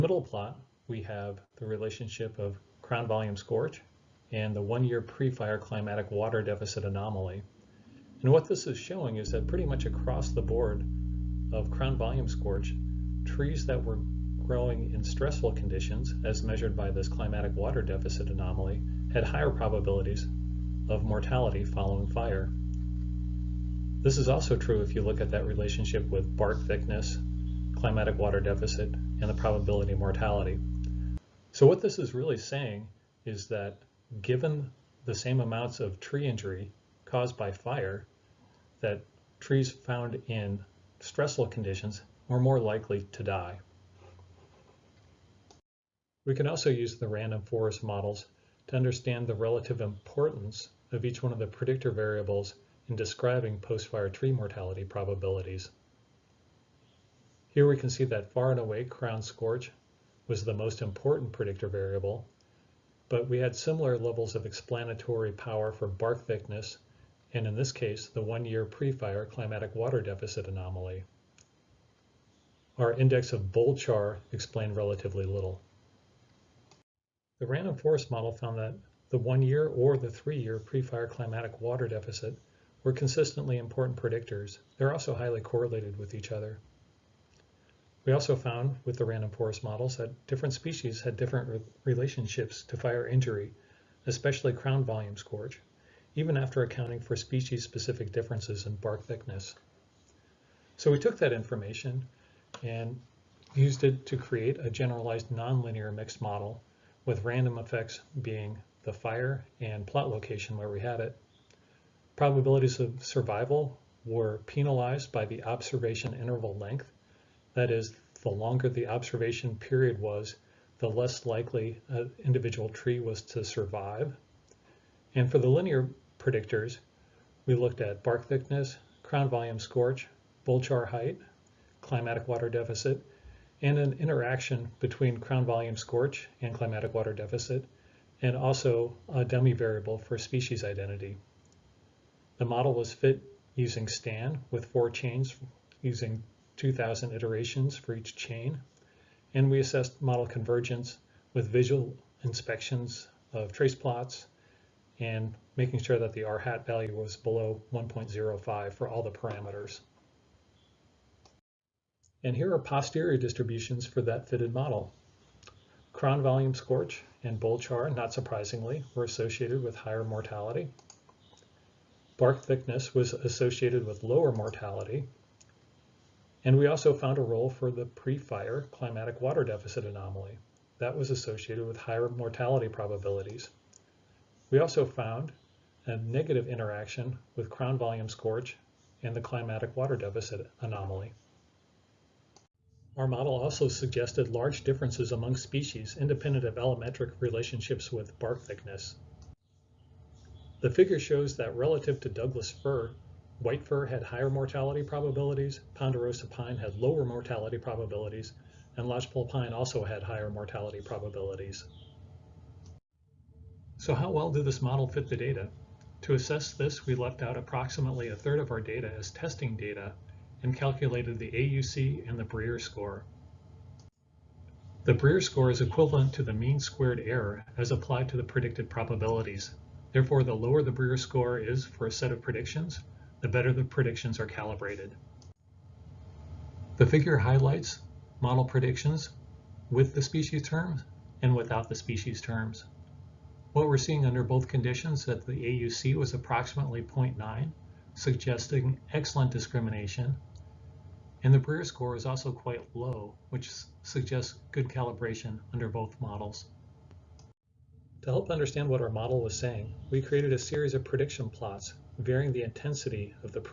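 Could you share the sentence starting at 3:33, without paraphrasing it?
So how well did this model fit the data?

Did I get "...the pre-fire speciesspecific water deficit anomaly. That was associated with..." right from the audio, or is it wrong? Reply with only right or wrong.
wrong.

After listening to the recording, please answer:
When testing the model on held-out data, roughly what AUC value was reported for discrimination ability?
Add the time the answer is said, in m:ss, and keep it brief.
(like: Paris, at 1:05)
0.9, at 4:06.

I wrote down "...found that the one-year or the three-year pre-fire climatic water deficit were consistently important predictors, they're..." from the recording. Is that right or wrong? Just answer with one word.
right.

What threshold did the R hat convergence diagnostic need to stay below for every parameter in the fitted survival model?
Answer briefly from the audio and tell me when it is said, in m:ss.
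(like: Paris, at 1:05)
1.05, at 2:37.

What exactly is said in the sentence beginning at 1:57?
That is, the longer the observation period was, the less likely an individual tree was to survive.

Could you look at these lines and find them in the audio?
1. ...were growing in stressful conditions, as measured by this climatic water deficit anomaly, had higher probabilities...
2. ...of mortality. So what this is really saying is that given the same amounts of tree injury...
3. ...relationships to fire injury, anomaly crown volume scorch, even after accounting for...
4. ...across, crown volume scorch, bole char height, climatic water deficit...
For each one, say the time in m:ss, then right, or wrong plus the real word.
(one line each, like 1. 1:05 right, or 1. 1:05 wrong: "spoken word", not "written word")
1. 0:13 right
2. 0:29 right
3. 1:31 wrong: "especially", not "anomaly"
4. 2:08 wrong: "thickness", not "across".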